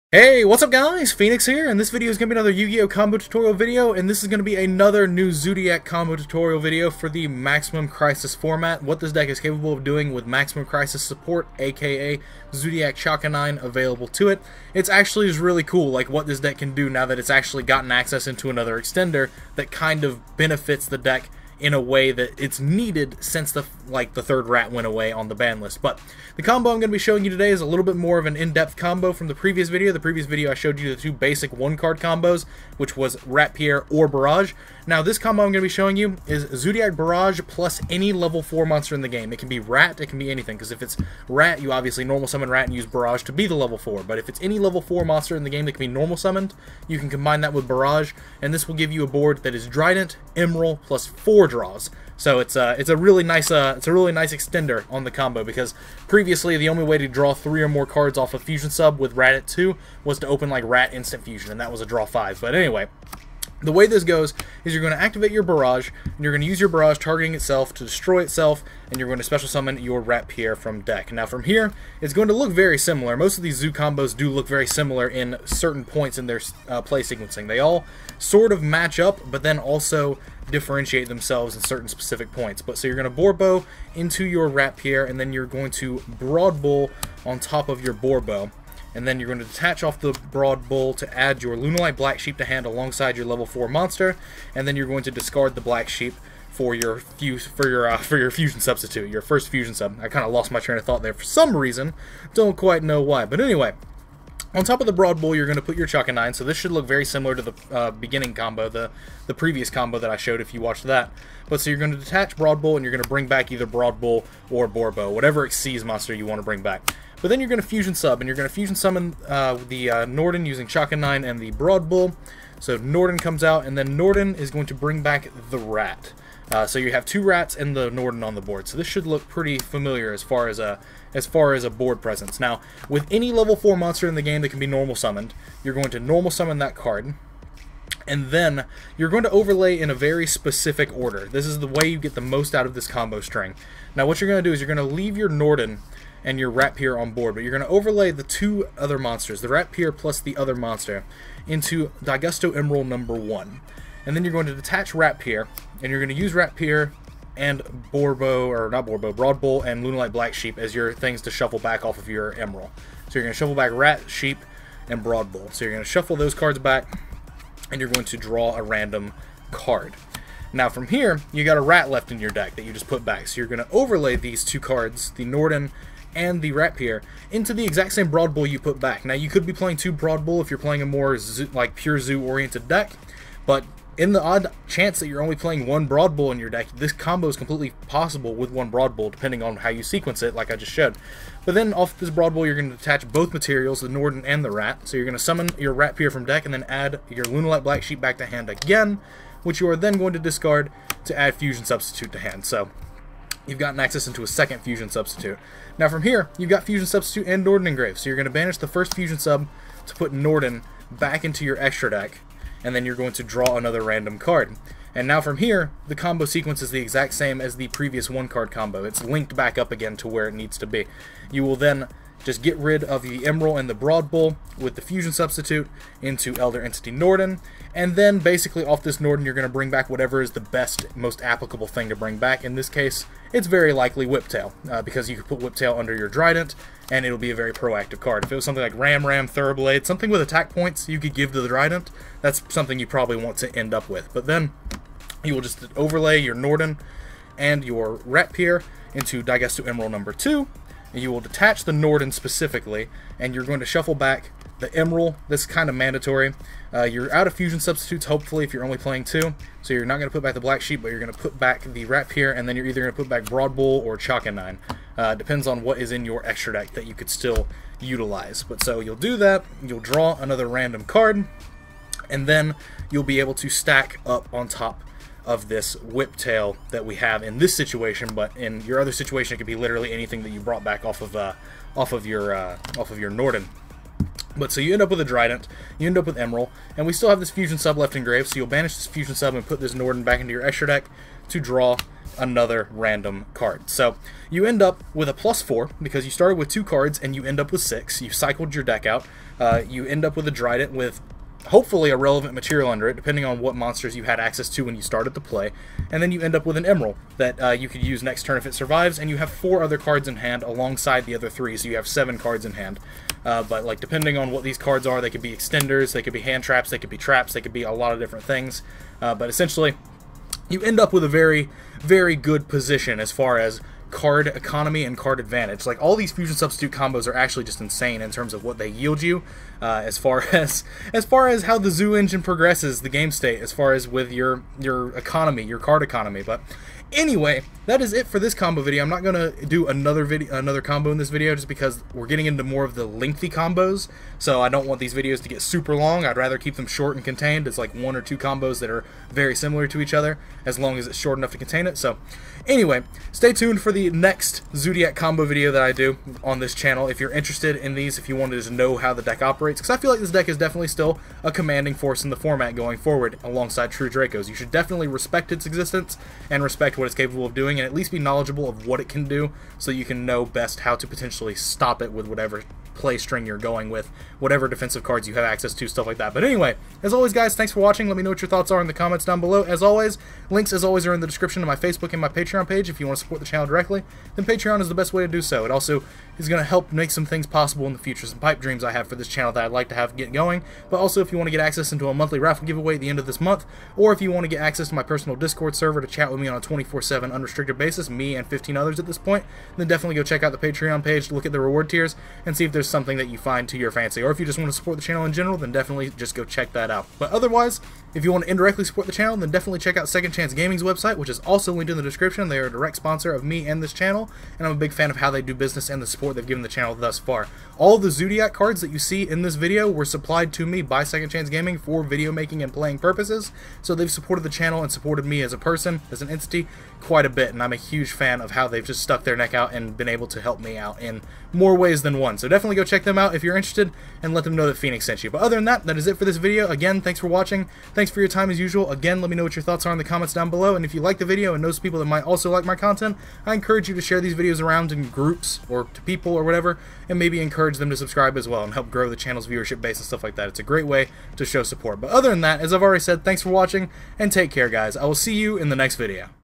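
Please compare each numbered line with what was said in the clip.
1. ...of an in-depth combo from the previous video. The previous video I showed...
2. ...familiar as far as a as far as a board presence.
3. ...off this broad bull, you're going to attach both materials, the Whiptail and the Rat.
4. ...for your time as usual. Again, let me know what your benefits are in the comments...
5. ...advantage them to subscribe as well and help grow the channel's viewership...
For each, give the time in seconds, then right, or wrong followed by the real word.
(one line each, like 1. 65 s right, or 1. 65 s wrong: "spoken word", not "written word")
1. 28 s right
2. 129 s right
3. 191 s wrong: "Norden", not "Whiptail"
4. 437 s wrong: "thoughts", not "benefits"
5. 447 s wrong: "encourage", not "advantage".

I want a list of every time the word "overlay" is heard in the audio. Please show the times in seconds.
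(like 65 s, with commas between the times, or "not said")
139 s, 147 s, 173 s, 245 s.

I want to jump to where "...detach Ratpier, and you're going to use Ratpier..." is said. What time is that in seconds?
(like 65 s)
154 s.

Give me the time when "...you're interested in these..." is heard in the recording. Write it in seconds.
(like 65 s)
356 s.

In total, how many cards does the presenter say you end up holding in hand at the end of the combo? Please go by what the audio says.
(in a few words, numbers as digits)
7.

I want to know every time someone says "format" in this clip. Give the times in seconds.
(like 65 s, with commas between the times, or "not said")
8 s, 362 s.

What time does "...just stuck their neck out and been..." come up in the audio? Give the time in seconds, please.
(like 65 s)
428 s.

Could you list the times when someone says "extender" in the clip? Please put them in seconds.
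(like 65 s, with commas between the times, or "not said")
18 s, 54 s, 315 s.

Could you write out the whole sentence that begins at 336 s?
But Anyway, that is it for this combo video.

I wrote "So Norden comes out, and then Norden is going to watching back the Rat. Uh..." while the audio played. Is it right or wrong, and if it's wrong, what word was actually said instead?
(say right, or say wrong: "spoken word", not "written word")
wrong: "bring", not "watching".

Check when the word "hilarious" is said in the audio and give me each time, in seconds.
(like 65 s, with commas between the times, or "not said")
not said.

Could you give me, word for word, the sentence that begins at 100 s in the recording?
I kind of lost my train of thought there for some reason, don't quite know why, but anyway.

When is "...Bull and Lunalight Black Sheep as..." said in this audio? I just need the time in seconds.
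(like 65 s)
159 s.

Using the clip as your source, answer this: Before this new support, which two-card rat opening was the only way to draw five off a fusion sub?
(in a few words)
Rat Instant Fusion.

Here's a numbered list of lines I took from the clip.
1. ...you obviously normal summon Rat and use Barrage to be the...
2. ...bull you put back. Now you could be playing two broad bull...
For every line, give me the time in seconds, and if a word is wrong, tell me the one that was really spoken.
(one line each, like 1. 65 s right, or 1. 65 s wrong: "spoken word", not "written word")
1. 41 s right
2. 178 s right.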